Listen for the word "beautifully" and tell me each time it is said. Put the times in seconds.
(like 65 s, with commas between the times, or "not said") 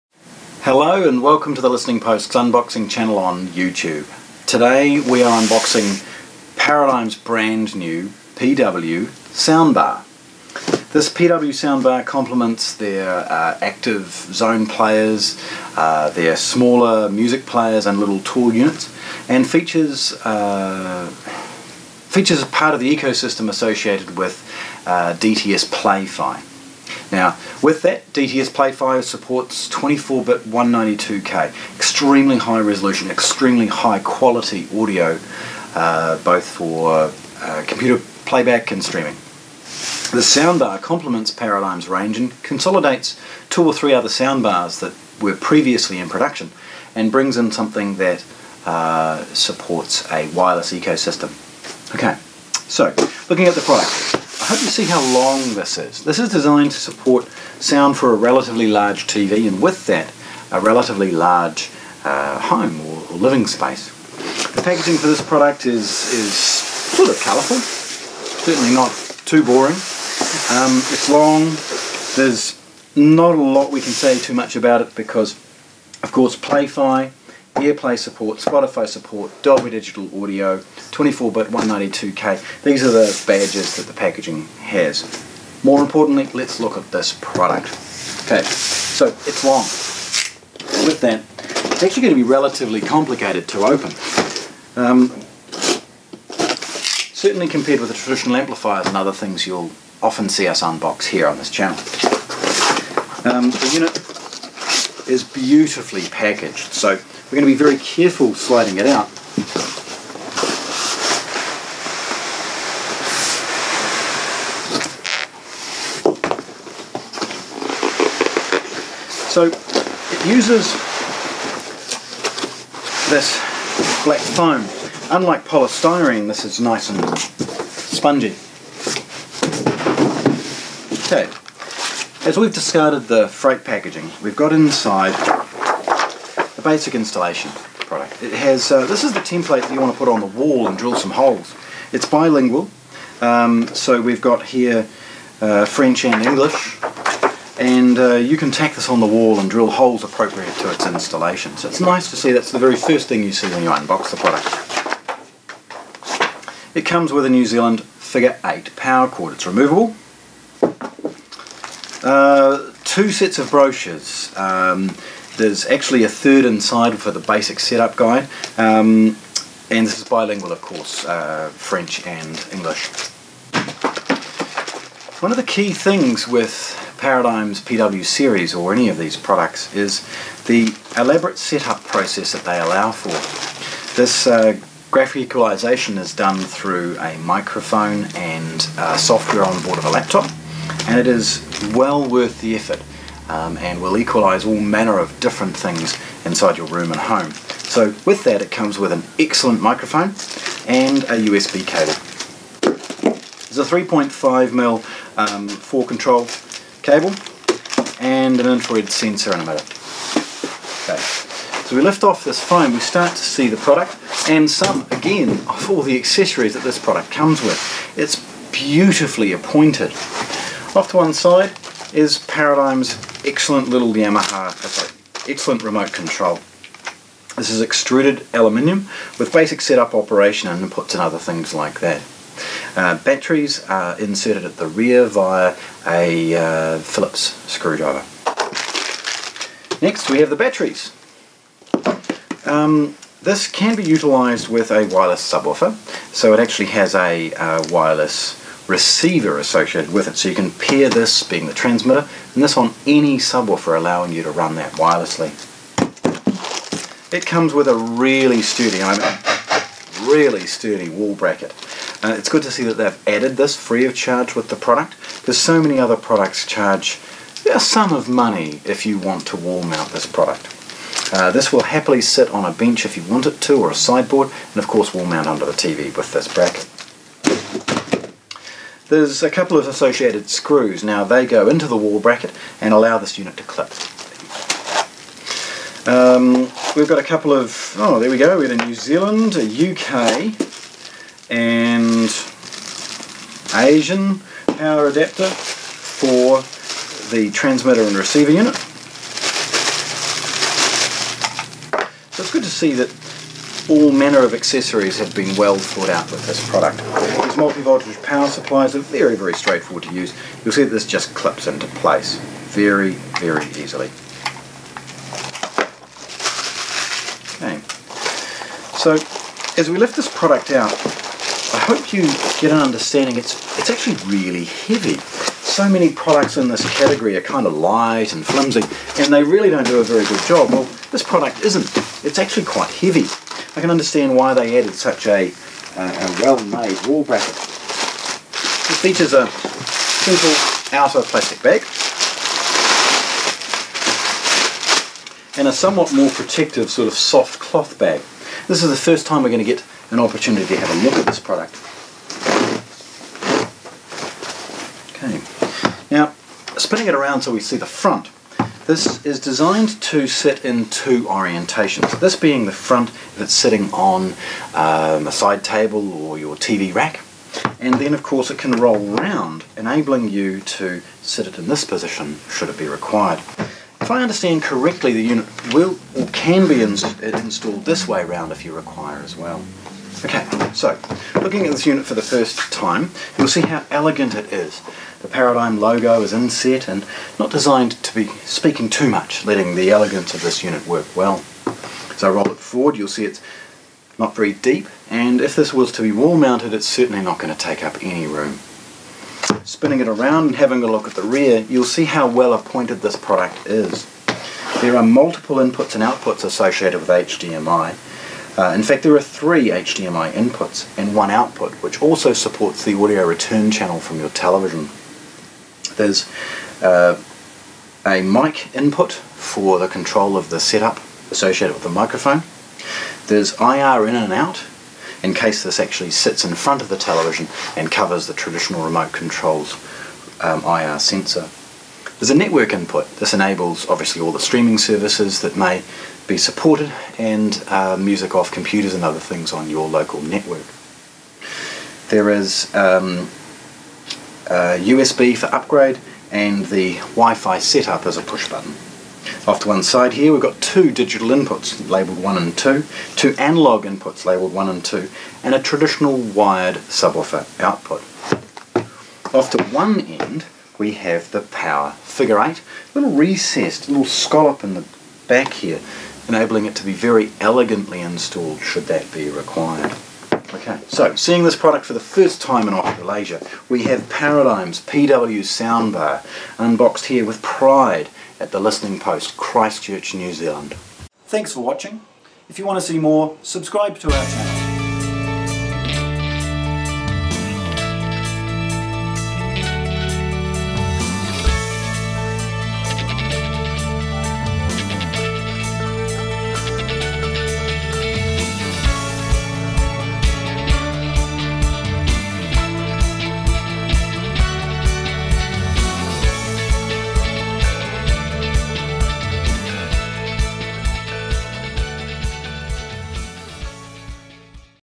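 105 s, 218 s.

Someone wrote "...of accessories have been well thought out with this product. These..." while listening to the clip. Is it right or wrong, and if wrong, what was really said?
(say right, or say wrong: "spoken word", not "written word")
right.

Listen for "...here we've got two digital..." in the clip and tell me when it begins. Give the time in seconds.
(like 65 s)
449 s.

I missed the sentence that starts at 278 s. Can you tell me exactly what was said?
There's a couple of associated screws.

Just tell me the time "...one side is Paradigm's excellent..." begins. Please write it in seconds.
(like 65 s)
220 s.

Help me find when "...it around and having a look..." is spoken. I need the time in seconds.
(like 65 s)
399 s.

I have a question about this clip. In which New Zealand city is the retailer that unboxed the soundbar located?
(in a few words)
Christchurch.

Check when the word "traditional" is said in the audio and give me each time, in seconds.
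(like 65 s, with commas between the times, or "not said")
97 s, 428 s, 455 s.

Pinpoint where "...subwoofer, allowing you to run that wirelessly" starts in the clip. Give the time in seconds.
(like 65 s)
253 s.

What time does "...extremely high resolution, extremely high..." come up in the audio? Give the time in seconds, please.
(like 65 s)
31 s.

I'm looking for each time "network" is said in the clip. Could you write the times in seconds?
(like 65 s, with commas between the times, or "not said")
432 s, 440 s.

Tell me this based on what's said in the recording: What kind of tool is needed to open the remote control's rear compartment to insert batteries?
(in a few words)
Phillips screwdriver.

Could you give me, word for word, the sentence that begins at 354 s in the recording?
Okay, now spinning it around so we see the front.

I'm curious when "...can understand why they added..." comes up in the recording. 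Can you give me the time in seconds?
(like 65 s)
333 s.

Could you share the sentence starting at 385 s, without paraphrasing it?
The Paradigm logo is inset and not designed to be speaking too much, letting the elegance of this unit work well.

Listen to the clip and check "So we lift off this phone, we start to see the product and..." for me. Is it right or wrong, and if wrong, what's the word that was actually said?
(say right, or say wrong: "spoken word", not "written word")
right.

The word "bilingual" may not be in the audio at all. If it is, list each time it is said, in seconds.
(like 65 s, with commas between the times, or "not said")
142 s, 170 s.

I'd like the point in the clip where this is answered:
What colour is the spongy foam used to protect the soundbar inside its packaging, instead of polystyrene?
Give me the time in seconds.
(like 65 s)
124 s.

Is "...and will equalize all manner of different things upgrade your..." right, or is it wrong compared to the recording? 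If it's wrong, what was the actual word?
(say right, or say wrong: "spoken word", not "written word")
wrong: "inside", not "upgrade".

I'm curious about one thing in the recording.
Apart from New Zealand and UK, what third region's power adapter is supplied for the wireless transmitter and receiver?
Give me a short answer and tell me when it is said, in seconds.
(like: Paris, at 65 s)
Asian, at 293 s.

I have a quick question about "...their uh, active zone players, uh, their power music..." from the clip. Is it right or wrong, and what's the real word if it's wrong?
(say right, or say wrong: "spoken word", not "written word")
wrong: "smaller", not "power".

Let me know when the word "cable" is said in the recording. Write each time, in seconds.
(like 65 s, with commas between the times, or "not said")
201 s, 206 s.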